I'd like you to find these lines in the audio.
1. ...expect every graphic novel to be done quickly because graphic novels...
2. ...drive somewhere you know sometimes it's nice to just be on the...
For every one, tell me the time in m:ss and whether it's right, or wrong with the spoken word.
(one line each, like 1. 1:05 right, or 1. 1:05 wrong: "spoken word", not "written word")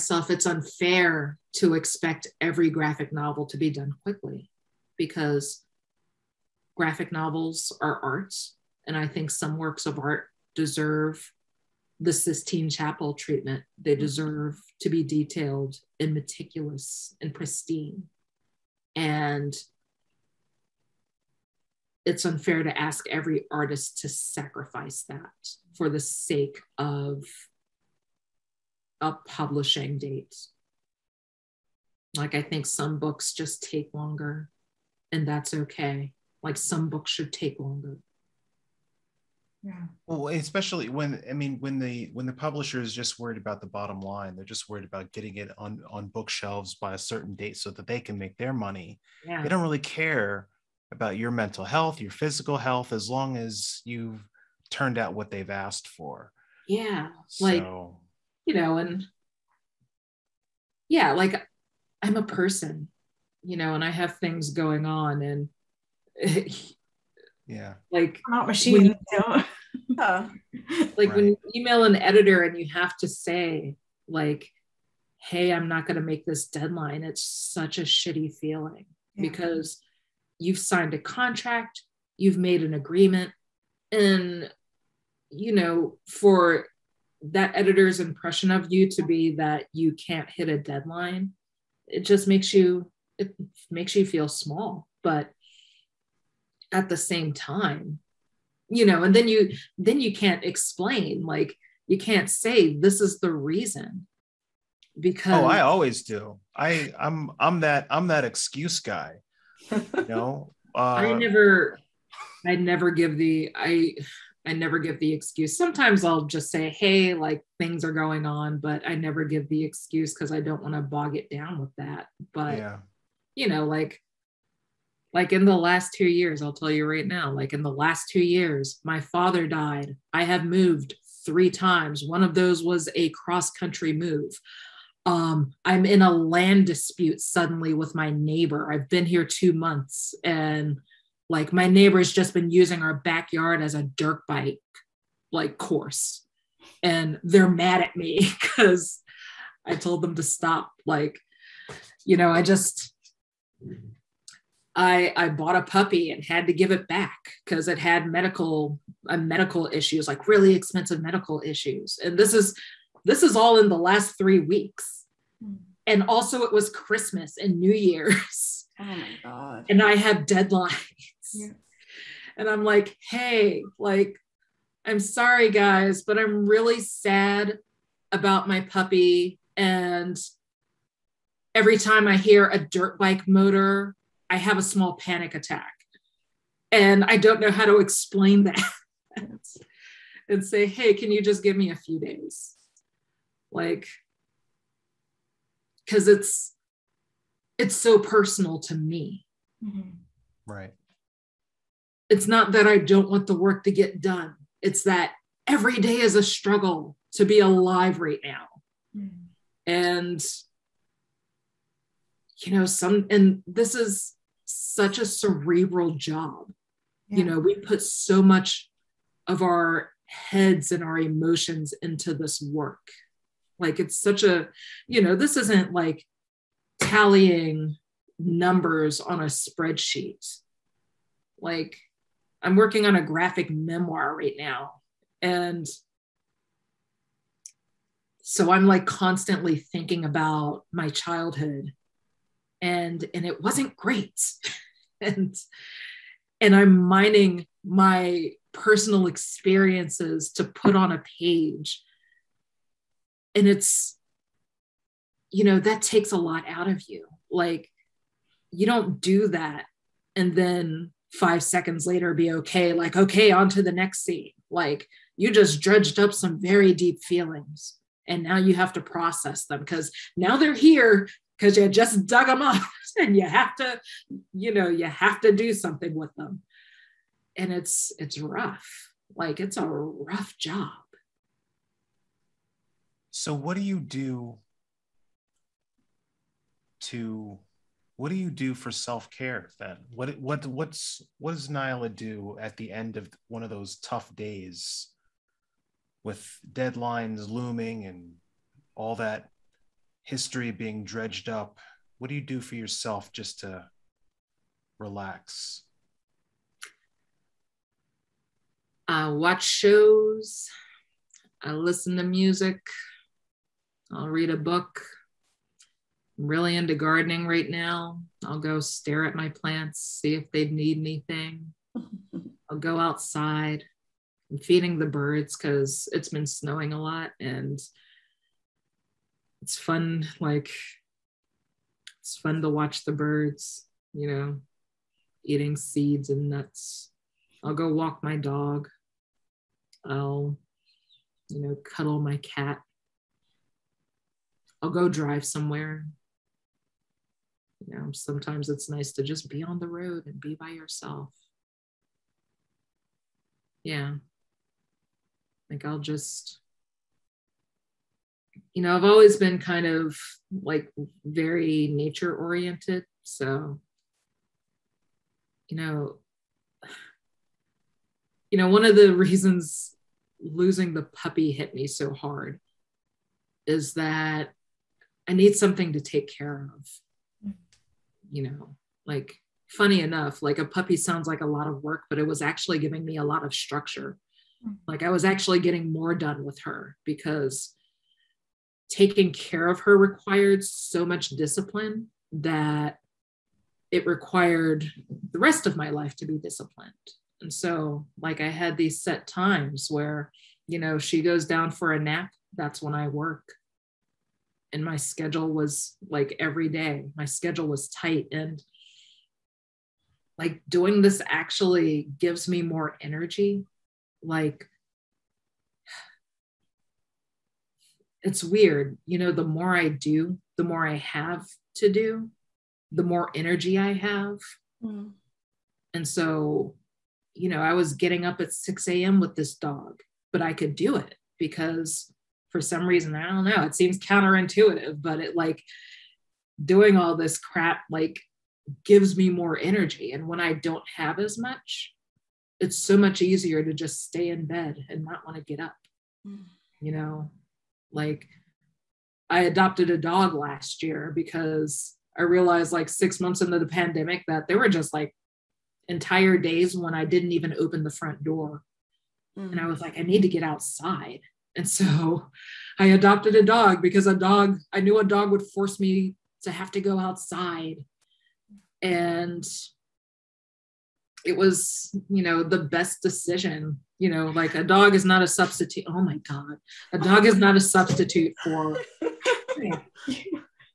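1. 0:01 right
2. 5:44 right.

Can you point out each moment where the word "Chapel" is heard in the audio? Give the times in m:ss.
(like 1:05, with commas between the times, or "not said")
0:12.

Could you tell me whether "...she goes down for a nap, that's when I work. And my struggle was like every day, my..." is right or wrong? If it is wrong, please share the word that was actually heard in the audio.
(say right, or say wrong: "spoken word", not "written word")
wrong: "schedule", not "struggle".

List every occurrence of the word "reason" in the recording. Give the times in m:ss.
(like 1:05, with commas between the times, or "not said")
1:43, 6:08, 7:12.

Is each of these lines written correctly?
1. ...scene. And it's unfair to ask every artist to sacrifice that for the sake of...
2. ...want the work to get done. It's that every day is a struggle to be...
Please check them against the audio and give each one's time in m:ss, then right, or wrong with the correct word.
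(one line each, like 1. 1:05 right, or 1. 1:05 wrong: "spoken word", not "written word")
1. 0:17 wrong: "pristine", not "scene"
2. 3:23 right.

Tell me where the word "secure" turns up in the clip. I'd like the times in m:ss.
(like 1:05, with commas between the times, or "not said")
not said.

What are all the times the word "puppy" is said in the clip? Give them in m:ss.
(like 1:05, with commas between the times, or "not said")
2:35, 2:58, 6:10, 6:20.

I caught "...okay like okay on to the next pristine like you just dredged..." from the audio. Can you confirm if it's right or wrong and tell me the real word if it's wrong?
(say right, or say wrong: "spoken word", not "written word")
wrong: "scene", not "pristine".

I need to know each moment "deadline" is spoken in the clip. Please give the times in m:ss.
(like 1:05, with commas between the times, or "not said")
1:16, 1:30, 2:50, 4:56.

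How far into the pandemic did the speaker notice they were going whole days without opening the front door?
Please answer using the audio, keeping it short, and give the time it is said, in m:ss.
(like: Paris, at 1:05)
6 months, at 7:32.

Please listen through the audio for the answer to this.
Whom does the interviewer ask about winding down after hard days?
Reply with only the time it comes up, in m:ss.
4:51.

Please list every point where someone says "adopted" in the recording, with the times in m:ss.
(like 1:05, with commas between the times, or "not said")
7:29, 7:42.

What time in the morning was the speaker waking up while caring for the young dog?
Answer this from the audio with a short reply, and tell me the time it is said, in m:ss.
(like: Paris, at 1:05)
6 a.m., at 7:08.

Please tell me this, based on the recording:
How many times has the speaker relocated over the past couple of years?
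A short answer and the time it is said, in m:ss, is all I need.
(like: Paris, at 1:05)
3, at 2:11.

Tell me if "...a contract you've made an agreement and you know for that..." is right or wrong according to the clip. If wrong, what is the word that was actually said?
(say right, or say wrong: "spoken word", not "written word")
right.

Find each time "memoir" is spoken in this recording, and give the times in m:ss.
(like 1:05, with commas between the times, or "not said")
3:53.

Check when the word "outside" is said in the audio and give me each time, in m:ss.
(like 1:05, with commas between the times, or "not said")
5:22, 7:40, 7:46.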